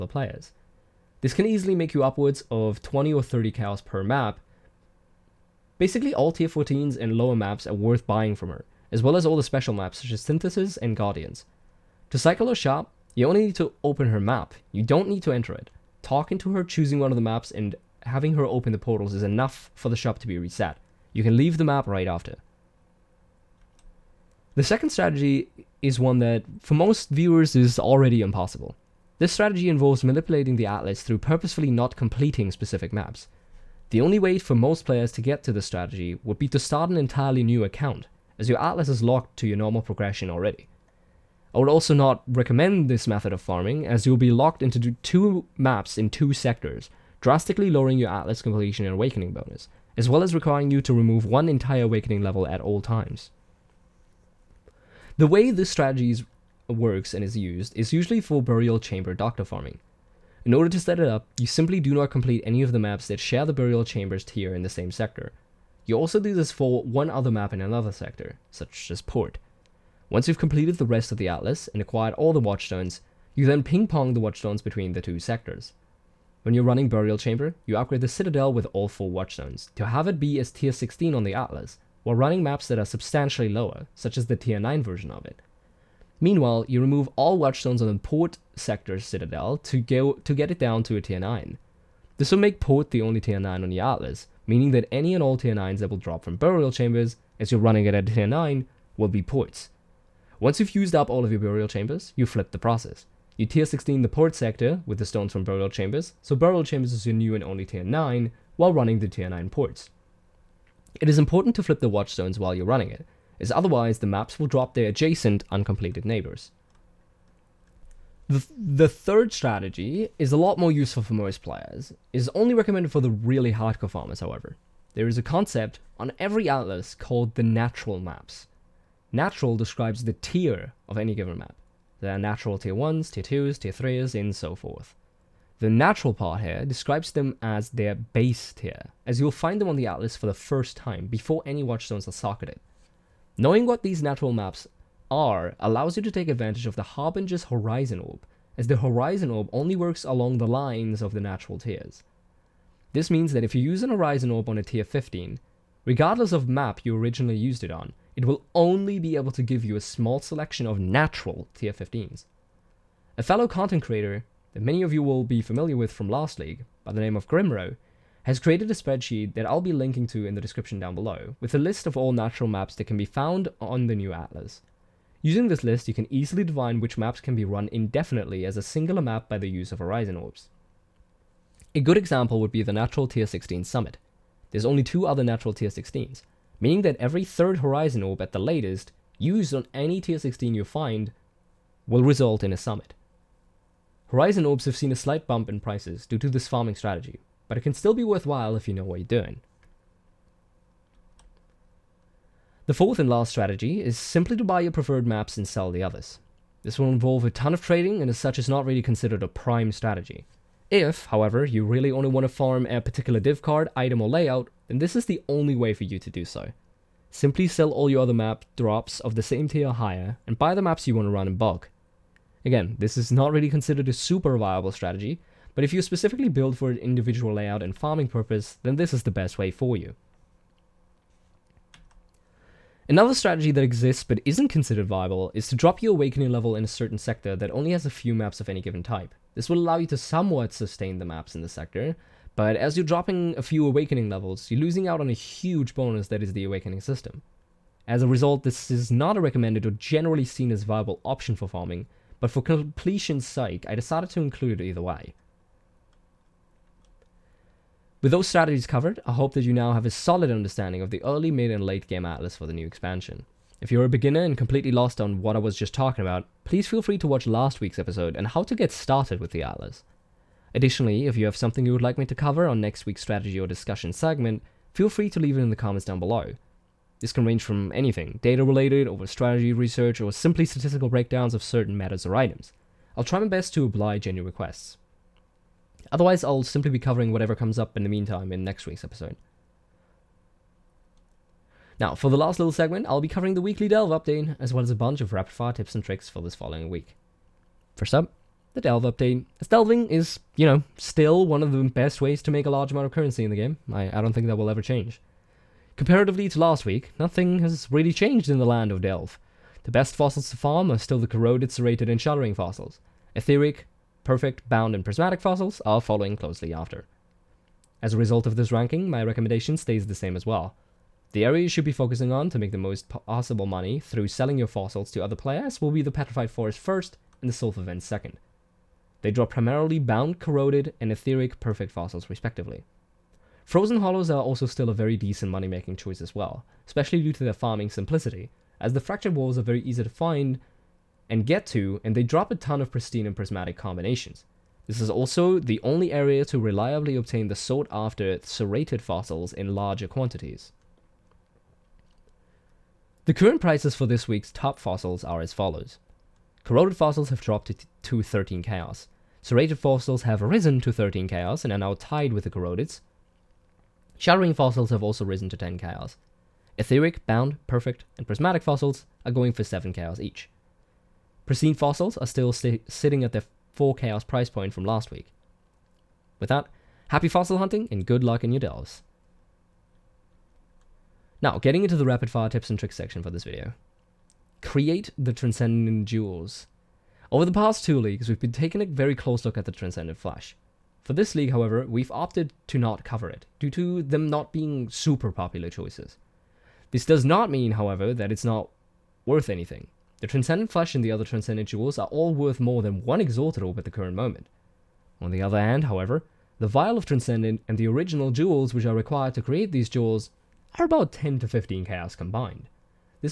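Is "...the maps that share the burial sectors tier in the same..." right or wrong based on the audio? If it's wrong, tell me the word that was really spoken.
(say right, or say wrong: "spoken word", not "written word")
wrong: "chambers", not "sectors".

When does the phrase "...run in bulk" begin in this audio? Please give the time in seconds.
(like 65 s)
221 s.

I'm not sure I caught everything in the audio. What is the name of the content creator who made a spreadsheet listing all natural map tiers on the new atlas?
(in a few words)
Grimro.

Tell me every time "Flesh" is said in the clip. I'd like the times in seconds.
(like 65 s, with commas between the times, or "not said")
389 s, 400 s.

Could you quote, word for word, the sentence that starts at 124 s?
There is a concept on every atlas called the natural maps.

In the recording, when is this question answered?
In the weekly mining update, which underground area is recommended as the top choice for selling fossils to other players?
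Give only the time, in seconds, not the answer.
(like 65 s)
325 s.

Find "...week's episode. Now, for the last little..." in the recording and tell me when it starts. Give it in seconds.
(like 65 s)
288 s.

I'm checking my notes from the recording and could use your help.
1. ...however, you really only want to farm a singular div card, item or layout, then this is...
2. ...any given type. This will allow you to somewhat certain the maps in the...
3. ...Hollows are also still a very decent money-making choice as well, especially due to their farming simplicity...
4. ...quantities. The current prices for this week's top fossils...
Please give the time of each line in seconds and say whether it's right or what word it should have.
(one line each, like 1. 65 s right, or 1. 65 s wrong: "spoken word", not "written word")
1. 211 s wrong: "particular", not "singular"
2. 238 s wrong: "sustain", not "certain"
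3. 333 s right
4. 349 s right.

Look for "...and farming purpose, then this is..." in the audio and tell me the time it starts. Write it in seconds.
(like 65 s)
227 s.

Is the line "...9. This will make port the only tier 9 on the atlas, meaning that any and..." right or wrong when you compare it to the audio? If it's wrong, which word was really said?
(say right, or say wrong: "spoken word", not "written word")
right.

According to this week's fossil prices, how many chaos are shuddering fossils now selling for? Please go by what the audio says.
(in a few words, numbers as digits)
10 chaos.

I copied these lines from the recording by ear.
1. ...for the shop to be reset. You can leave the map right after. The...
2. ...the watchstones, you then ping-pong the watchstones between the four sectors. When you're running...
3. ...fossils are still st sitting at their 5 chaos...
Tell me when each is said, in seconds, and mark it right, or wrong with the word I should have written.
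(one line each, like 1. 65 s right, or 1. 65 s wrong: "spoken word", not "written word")
1. 19 s right
2. 72 s wrong: "two", not "four"
3. 371 s wrong: "4", not "5".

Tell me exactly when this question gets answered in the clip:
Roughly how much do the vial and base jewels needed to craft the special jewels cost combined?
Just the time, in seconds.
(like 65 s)
410 s.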